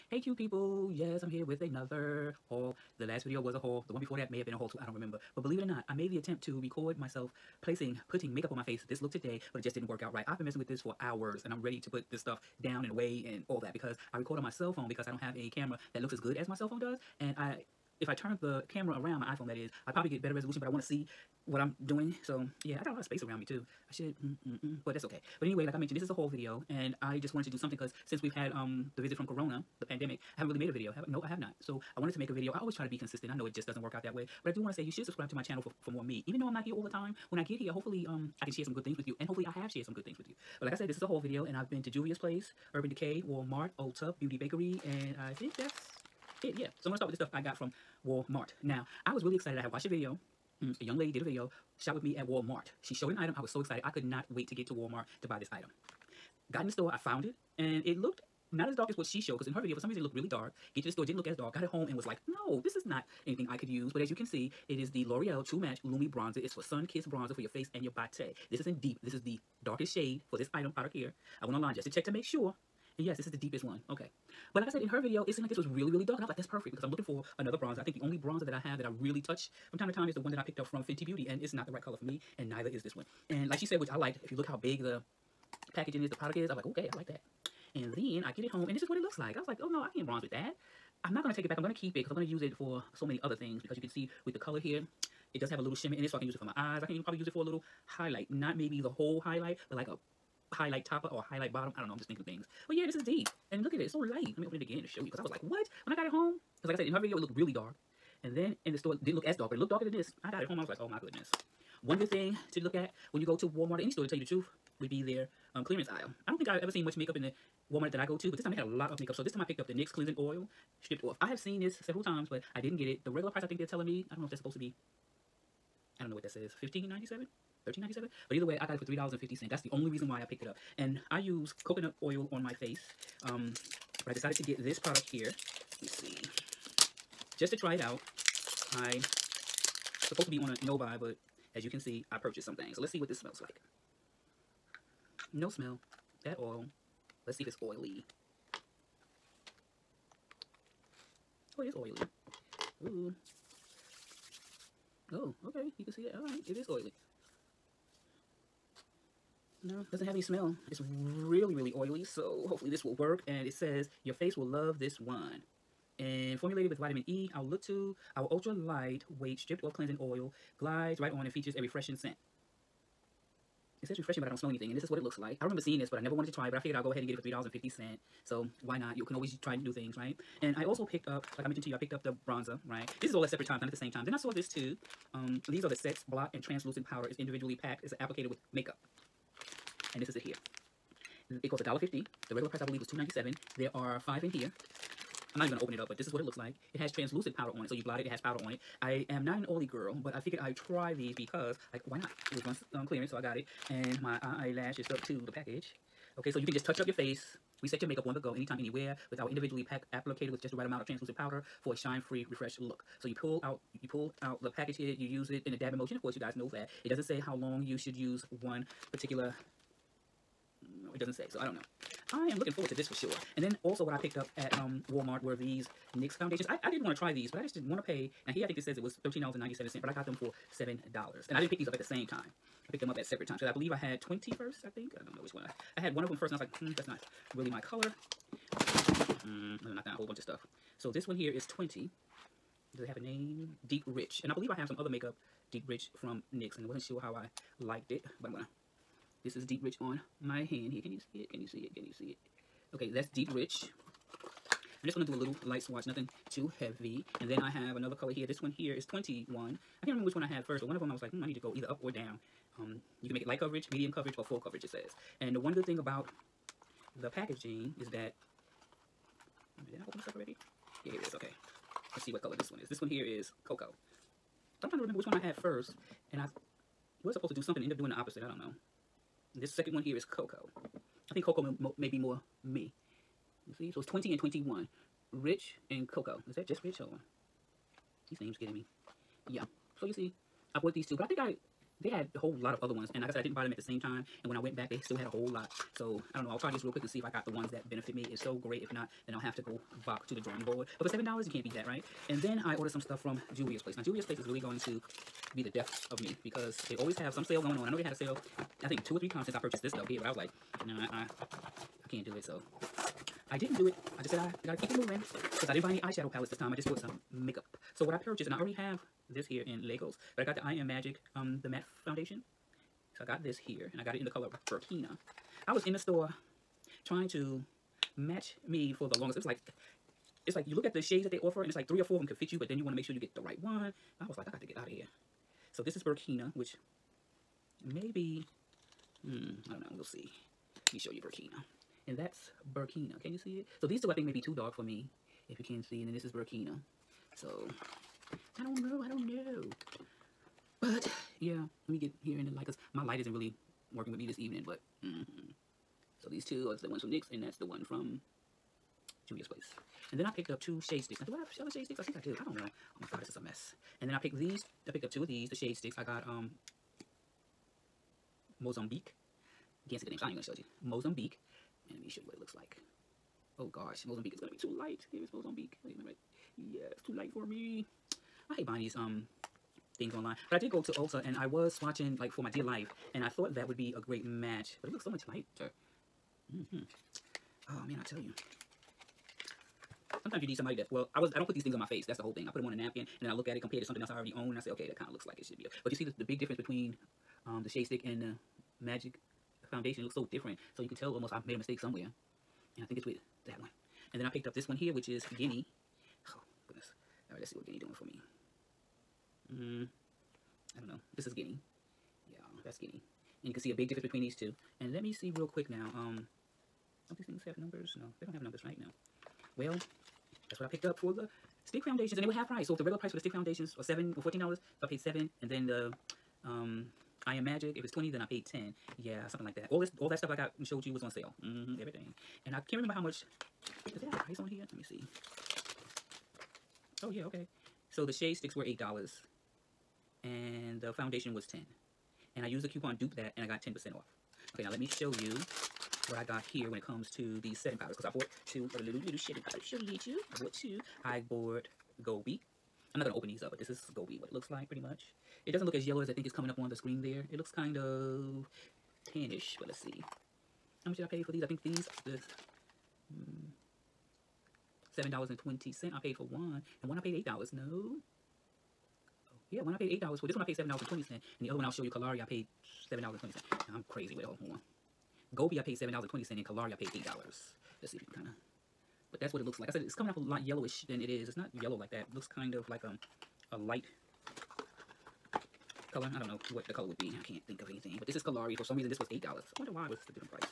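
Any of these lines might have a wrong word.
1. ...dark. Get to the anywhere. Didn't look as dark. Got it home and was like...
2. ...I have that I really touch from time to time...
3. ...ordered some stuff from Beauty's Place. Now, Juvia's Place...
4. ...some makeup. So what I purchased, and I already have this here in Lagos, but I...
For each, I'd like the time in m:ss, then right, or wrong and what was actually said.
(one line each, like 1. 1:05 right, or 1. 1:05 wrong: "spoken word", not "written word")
1. 1:00 wrong: "store", not "anywhere"
2. 1:18 right
3. 5:02 wrong: "Juvia", not "Beauty"
4. 5:16 right.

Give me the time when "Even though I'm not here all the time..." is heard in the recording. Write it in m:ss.
0:36.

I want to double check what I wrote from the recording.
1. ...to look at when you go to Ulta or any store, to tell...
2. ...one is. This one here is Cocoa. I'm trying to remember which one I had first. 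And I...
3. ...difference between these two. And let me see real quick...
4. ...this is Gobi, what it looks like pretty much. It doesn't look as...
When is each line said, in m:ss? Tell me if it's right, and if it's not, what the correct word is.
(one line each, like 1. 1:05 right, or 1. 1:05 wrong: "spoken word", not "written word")
1. 1:52 wrong: "Walmart", not "Ulta"
2. 4:32 right
3. 6:53 right
4. 7:33 right.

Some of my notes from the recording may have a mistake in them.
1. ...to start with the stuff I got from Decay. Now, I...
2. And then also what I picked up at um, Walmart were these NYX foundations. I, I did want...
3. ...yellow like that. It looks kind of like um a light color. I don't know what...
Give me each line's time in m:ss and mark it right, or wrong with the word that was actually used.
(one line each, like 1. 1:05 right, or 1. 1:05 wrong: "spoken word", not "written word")
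1. 0:46 wrong: "Walmart", not "Decay"
2. 3:43 right
3. 8:01 right.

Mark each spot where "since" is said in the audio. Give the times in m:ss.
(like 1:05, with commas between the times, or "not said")
0:28, 5:09.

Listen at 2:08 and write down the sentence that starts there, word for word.
But either way, I got it for $3.50.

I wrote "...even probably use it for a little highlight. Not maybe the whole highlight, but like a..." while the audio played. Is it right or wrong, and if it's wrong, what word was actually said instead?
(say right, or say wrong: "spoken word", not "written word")
right.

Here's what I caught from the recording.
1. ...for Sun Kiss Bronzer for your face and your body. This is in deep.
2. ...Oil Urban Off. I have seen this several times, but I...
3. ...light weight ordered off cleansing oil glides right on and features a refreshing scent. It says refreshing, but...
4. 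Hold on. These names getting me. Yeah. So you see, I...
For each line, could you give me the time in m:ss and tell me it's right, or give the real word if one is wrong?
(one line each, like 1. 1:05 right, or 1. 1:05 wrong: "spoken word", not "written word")
1. 1:06 right
2. 2:00 wrong: "Stripped", not "Urban"
3. 2:48 wrong: "stripped", not "ordered"
4. 4:46 right.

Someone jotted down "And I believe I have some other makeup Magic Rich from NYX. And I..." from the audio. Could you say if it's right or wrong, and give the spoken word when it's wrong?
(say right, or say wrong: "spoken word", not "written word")
wrong: "Deep", not "Magic".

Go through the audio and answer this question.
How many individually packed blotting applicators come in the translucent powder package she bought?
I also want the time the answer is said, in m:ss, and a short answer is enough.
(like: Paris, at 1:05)
5, at 3:14.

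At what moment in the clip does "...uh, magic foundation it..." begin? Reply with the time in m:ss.
6:38.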